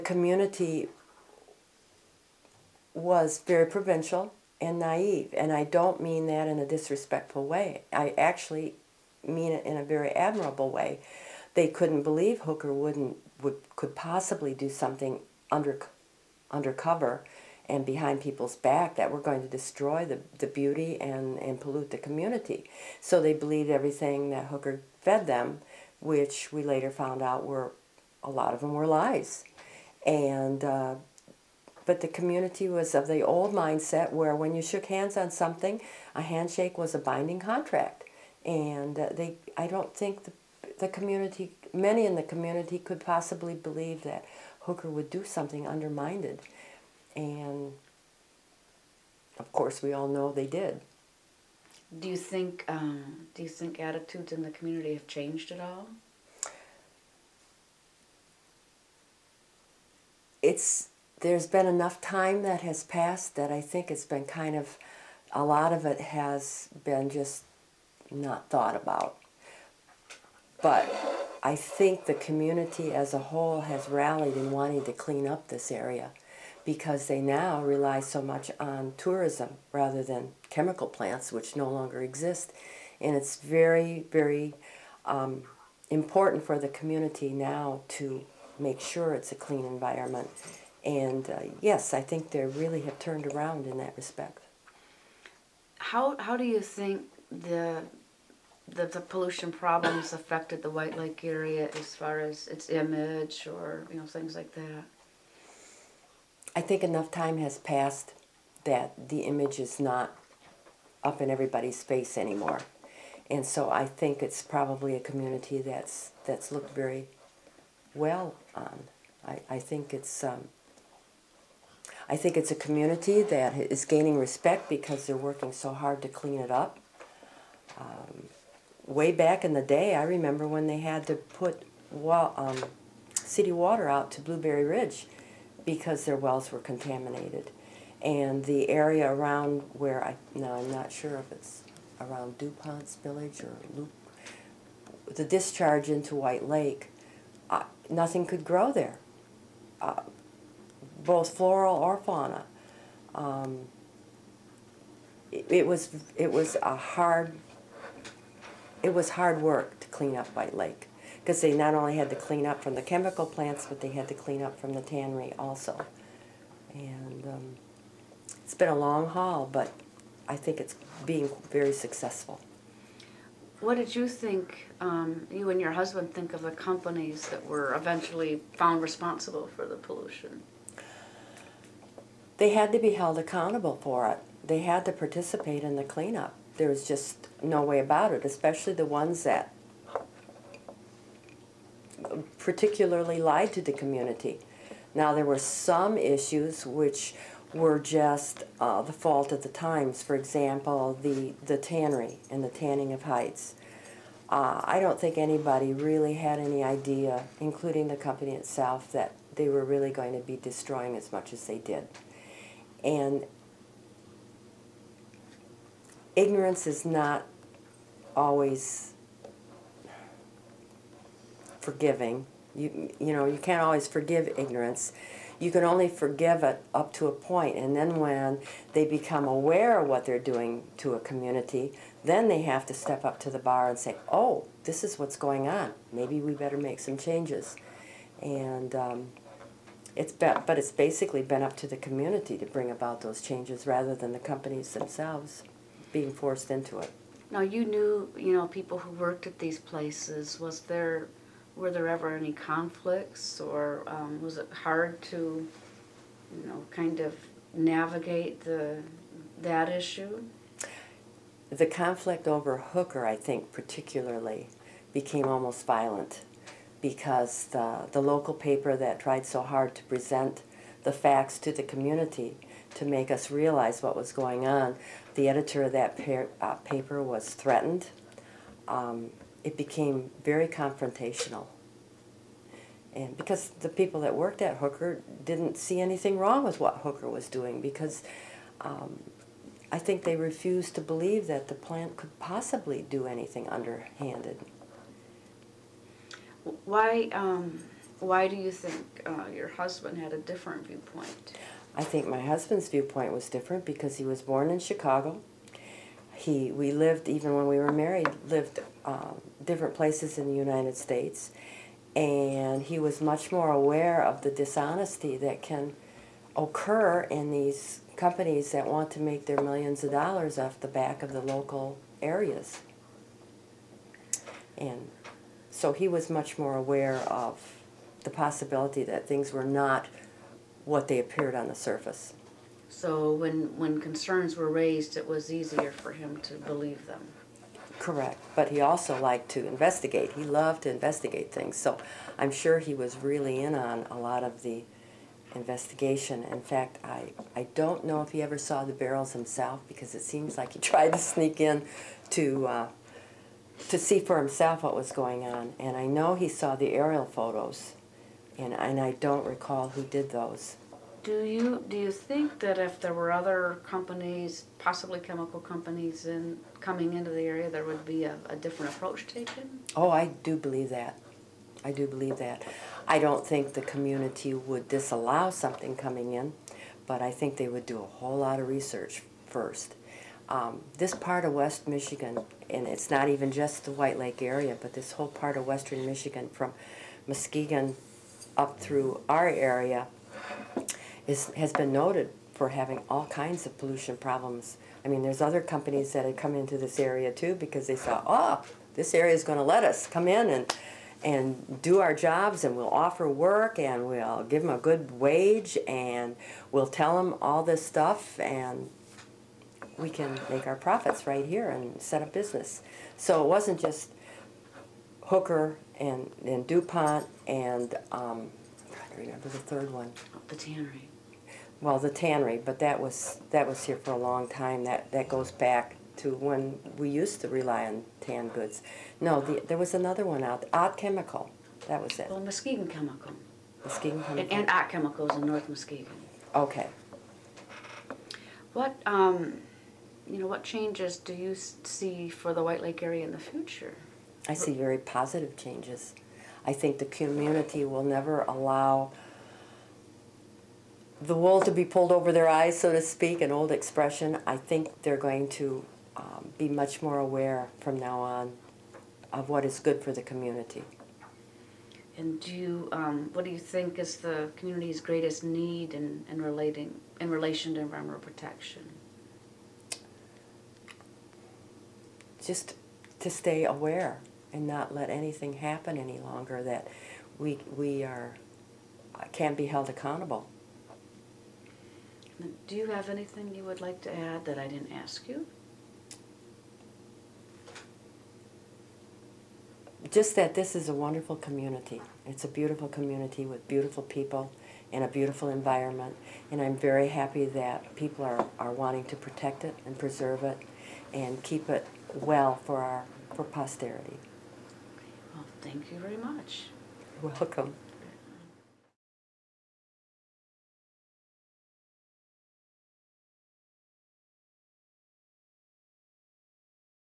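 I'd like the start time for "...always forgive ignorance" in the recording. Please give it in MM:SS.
03:43.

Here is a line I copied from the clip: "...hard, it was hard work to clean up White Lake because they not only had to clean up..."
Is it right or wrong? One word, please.
right.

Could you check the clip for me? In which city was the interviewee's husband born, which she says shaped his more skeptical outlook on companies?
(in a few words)
Chicago.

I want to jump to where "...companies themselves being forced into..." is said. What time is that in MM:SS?
04:04.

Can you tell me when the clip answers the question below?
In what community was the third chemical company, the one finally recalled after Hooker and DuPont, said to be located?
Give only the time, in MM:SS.
07:15.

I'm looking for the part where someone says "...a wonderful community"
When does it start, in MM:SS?
08:10.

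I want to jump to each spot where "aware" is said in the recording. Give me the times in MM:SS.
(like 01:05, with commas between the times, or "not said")
03:49, 05:13, 05:26, 07:36, 07:53.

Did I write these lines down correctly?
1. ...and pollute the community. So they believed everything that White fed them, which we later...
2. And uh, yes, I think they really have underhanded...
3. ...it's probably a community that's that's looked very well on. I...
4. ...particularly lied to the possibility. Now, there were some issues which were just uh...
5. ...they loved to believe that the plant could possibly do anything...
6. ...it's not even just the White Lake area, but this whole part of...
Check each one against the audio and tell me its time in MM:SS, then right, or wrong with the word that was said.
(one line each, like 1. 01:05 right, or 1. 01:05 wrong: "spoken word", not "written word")
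1. 00:21 wrong: "Hooker", not "White"
2. 01:30 wrong: "turned", not "underhanded"
3. 01:54 right
4. 03:12 wrong: "community", not "possibility"
5. 04:50 wrong: "refused", not "loved"
6. 06:22 right.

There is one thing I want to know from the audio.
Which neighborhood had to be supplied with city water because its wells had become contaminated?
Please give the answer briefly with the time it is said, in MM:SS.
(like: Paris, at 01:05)
Blueberry Ridge, at 02:14.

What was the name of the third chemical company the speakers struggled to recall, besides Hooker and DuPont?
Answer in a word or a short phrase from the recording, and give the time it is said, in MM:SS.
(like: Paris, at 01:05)
Ott Chemical, at 07:10.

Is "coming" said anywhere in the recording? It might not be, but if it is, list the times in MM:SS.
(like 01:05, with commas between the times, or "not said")
06:06, 06:15.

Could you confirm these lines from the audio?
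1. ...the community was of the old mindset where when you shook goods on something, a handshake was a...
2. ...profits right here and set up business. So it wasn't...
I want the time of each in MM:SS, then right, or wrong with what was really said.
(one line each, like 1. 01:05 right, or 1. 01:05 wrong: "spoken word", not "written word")
1. 00:32 wrong: "hands", not "goods"
2. 06:50 right.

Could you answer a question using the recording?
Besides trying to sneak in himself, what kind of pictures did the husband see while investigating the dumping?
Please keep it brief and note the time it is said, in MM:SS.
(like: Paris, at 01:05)
Aerial photos, at 05:56.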